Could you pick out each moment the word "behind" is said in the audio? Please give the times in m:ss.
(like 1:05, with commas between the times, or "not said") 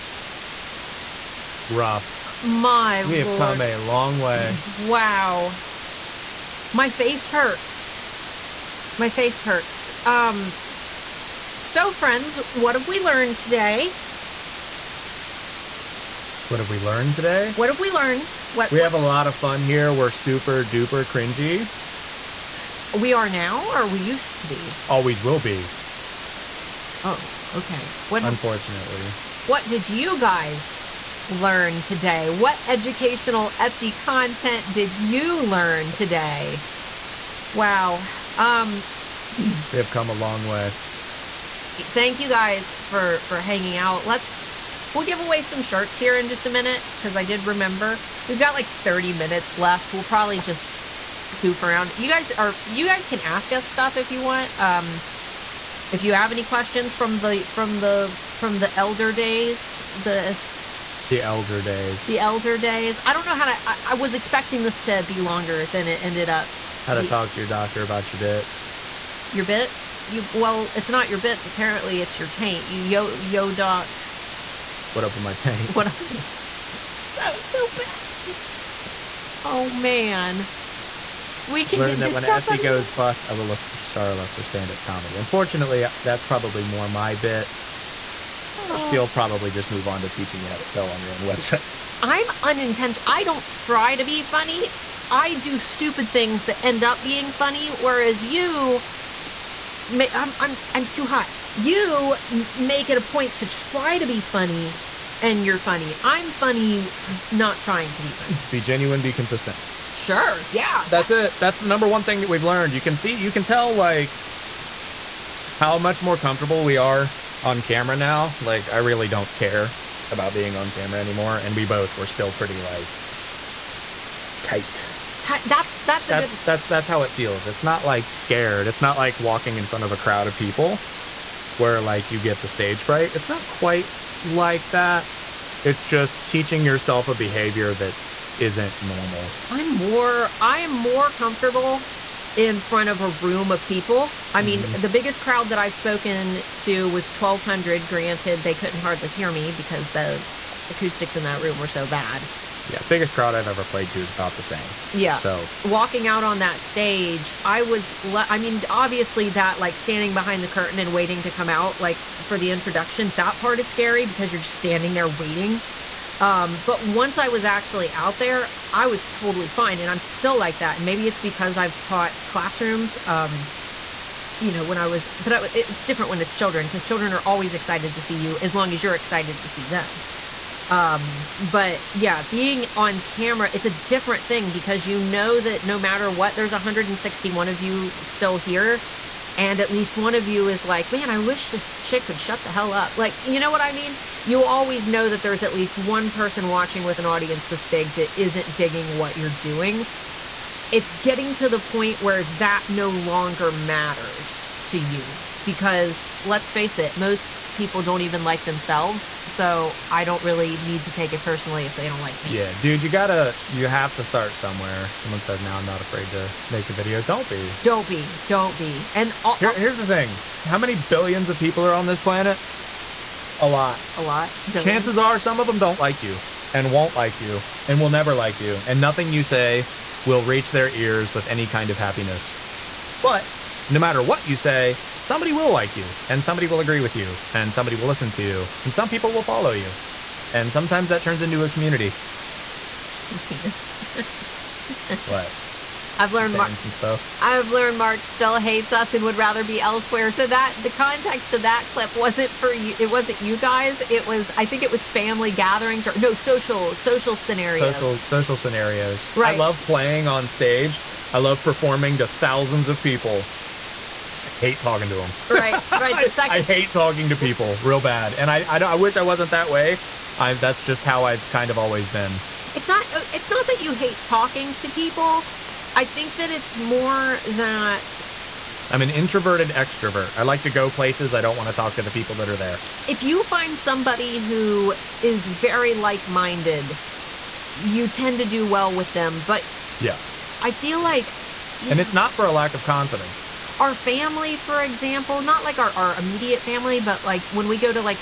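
2:40.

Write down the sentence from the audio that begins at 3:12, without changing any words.
Like, you know what I mean?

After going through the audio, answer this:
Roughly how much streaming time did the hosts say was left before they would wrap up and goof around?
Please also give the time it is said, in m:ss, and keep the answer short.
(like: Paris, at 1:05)
30 minutes, at 0:48.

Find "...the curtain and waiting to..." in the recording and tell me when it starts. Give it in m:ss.
2:40.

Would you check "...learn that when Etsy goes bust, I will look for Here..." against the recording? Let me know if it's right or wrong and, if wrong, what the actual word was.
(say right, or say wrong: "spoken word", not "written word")
wrong: "Starla", not "Here".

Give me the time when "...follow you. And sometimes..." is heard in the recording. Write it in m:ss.
3:59.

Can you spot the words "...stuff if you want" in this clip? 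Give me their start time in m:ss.
0:53.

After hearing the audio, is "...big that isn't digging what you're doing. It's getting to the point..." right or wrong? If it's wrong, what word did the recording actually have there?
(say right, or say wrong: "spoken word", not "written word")
right.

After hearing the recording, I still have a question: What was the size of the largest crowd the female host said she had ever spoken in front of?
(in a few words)
1200.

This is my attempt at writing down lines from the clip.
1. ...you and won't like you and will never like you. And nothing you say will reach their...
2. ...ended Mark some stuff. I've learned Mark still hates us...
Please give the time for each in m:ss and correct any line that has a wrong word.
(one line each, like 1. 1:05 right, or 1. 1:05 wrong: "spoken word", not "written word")
1. 3:46 right
2. 4:06 wrong: "learned", not "ended".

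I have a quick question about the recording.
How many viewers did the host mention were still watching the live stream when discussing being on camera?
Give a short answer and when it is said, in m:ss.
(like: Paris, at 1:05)
161, at 3:06.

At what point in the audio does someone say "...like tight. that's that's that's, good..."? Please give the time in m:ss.
2:02.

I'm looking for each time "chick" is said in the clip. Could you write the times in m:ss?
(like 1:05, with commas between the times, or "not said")
3:11.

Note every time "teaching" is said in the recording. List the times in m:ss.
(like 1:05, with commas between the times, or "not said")
1:30, 2:16.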